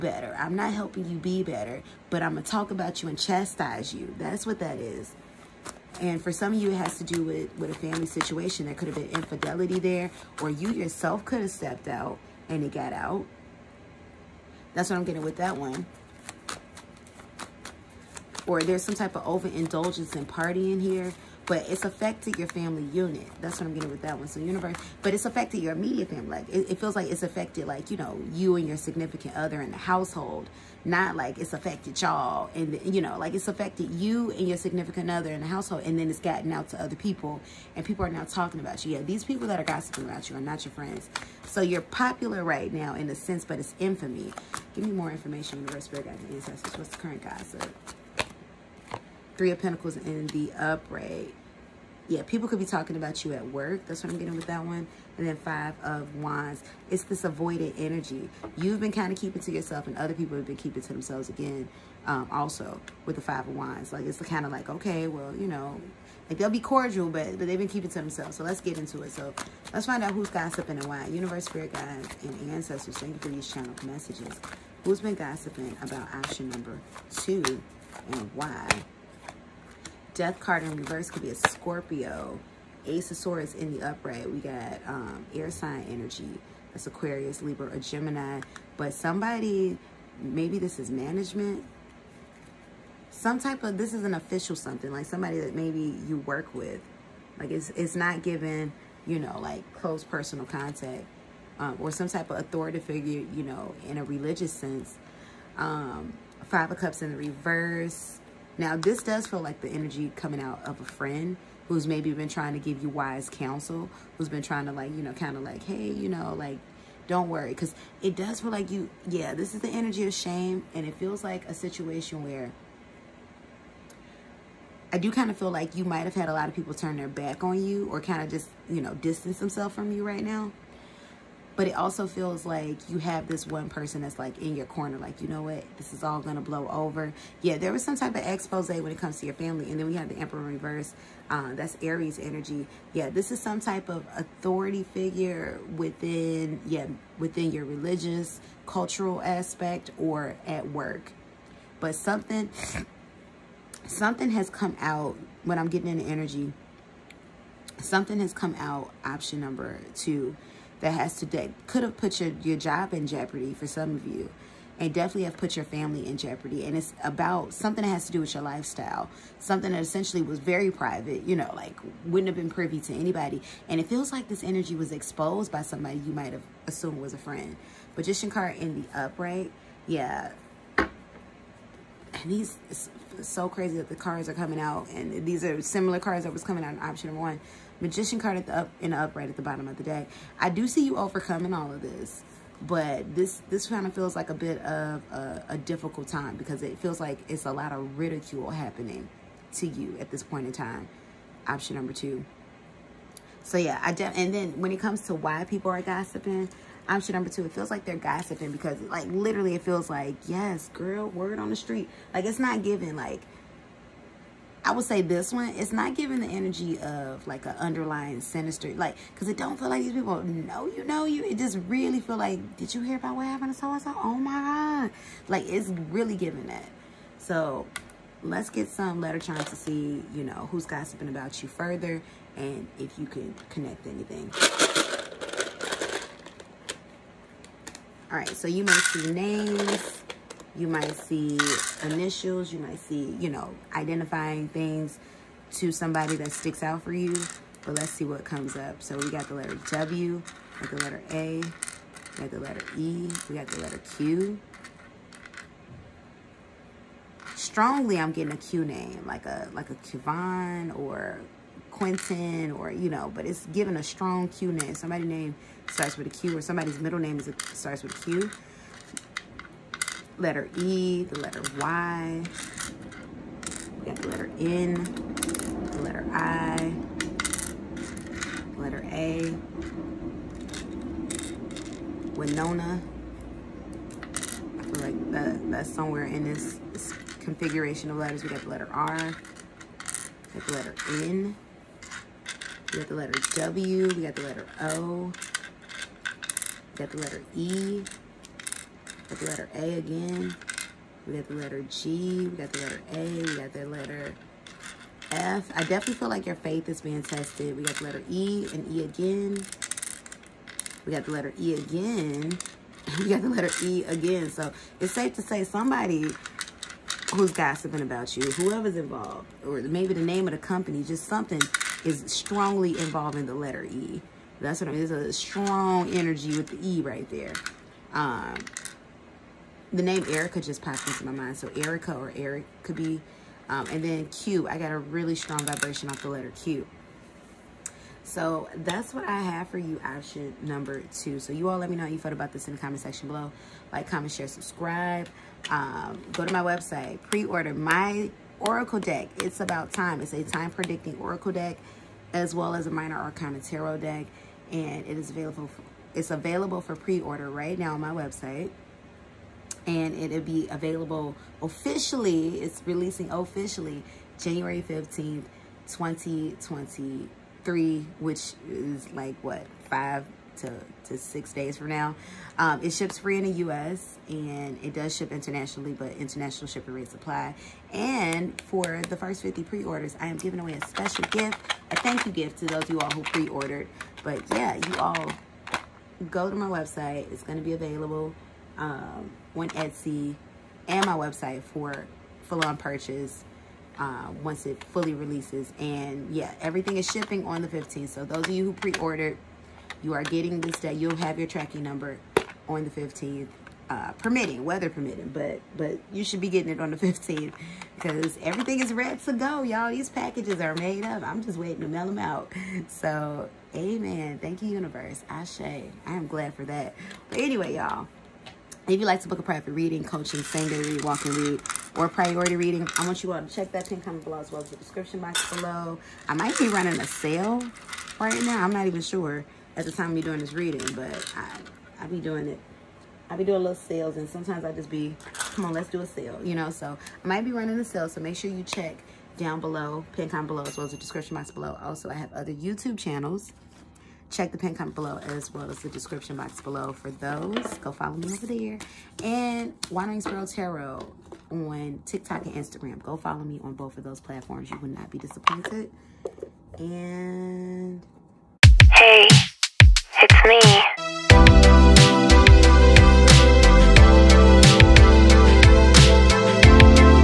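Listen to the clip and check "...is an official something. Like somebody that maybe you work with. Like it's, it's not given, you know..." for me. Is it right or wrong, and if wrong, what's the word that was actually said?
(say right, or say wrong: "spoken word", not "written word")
right.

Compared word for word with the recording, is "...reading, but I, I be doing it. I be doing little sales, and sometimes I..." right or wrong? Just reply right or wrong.
right.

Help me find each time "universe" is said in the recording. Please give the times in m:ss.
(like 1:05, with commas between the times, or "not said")
0:24, 0:45, 1:11, 6:54.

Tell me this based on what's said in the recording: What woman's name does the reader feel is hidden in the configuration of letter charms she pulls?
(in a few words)
Winona.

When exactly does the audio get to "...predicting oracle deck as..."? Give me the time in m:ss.
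5:50.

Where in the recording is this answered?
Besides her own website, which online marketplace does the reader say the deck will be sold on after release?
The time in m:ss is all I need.
6:29.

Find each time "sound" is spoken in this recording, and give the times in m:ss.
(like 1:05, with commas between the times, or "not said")
not said.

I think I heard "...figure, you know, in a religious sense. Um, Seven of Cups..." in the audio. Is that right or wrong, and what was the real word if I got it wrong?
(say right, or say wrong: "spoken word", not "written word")
wrong: "Five", not "Seven".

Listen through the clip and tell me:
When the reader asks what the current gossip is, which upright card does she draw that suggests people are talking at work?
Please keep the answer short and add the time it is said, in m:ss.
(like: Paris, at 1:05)
Three of Pentacles, at 0:49.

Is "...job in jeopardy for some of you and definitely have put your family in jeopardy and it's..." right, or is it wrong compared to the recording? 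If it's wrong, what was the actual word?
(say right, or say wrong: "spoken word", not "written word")
right.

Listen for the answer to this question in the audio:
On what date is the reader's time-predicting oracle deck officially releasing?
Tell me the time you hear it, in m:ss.
6:04.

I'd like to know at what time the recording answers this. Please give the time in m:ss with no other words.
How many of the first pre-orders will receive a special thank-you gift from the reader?
6:19.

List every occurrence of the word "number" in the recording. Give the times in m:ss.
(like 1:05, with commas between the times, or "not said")
1:16, 2:39, 3:07, 3:21, 3:27, 5:40, 6:41.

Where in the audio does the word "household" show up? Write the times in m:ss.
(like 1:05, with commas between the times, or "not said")
0:29, 0:35.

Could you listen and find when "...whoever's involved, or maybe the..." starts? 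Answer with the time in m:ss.
5:18.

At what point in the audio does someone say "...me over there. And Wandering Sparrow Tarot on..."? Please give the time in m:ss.
7:27.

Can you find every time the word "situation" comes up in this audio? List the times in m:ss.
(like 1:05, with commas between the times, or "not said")
0:08, 2:01.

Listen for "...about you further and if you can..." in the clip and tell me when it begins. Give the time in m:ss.
3:51.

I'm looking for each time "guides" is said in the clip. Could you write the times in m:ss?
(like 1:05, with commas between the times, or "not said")
0:46, 1:11.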